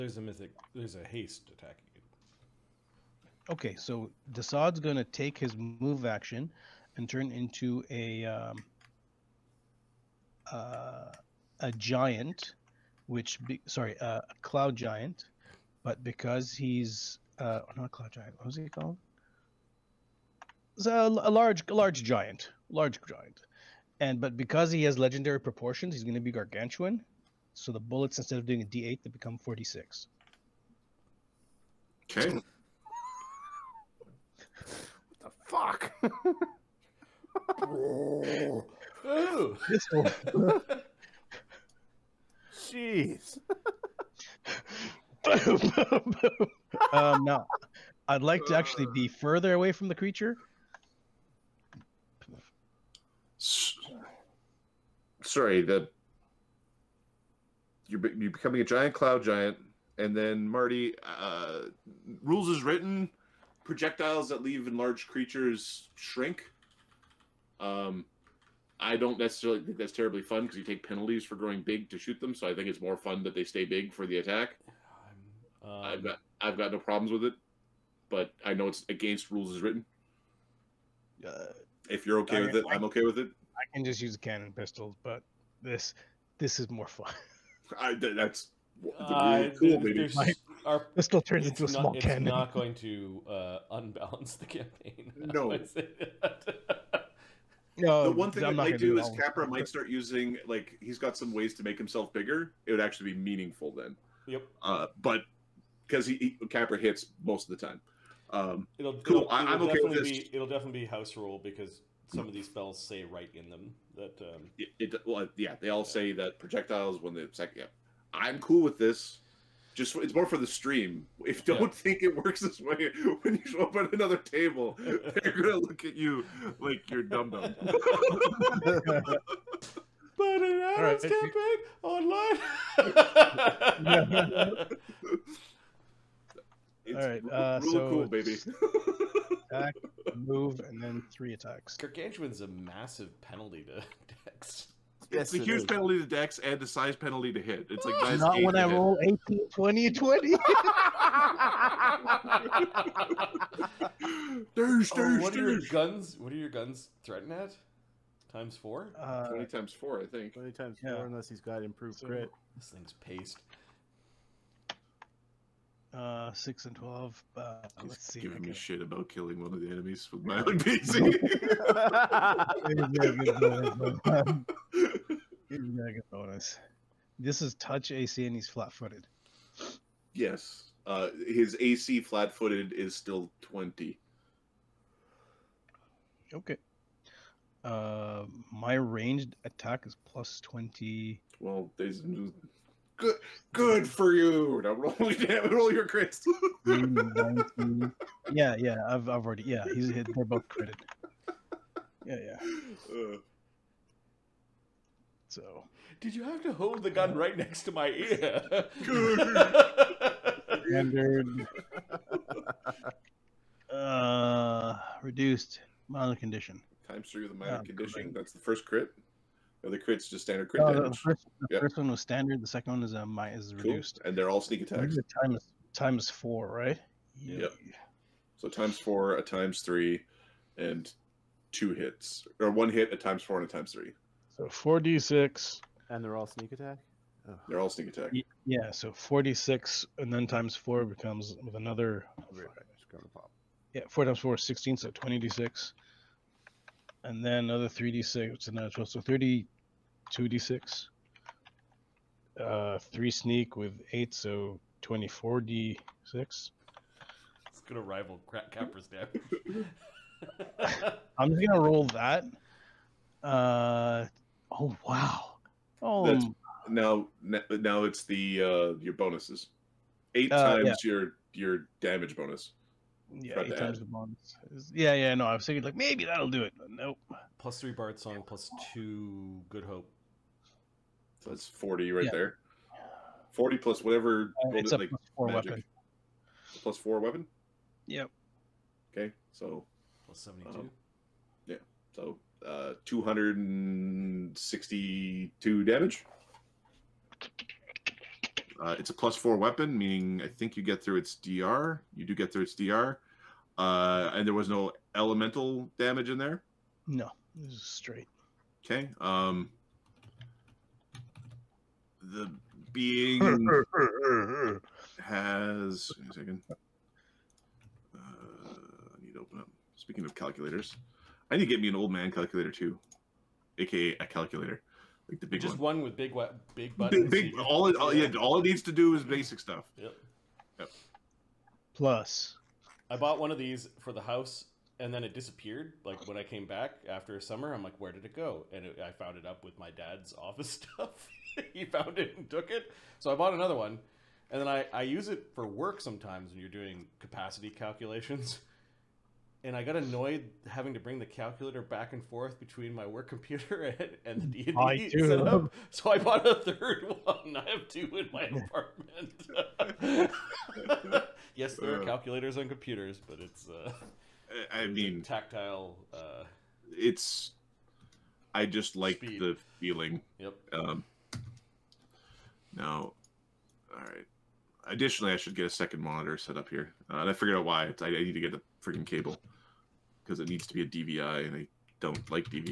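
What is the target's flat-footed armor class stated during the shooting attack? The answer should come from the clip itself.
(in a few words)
20.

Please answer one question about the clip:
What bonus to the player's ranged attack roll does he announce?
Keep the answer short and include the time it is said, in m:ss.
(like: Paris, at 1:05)
Plus 20, at 3:10.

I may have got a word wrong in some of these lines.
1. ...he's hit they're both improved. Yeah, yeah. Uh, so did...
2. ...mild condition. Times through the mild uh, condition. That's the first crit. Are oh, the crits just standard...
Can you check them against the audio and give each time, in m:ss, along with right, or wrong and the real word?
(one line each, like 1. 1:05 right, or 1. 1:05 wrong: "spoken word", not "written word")
1. 3:19 wrong: "critted", not "improved"
2. 3:35 right.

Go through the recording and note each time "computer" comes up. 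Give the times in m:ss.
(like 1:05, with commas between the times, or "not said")
5:53, 6:02.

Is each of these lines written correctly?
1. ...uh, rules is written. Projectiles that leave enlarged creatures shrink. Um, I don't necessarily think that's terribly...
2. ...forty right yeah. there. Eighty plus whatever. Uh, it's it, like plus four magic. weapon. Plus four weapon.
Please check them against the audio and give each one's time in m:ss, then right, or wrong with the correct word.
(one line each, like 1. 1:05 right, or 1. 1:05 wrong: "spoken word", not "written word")
1. 1:01 right
2. 4:41 wrong: "Forty", not "Eighty".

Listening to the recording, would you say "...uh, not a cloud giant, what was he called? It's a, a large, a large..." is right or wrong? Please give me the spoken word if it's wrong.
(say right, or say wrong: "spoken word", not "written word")
right.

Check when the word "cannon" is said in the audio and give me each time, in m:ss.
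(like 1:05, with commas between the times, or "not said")
1:24, 1:32.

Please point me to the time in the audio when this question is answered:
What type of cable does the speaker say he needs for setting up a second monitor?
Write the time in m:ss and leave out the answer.
6:20.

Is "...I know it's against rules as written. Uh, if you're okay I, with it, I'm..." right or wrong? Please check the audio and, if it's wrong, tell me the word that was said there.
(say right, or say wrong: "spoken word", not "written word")
right.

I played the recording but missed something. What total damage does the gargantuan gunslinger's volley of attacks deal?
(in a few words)
262.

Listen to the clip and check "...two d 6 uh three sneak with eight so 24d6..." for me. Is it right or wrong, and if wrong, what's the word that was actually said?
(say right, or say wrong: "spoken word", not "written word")
right.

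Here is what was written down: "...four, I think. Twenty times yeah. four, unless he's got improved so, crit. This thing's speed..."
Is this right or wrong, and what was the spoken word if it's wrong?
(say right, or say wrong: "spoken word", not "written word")
wrong: "paced", not "speed".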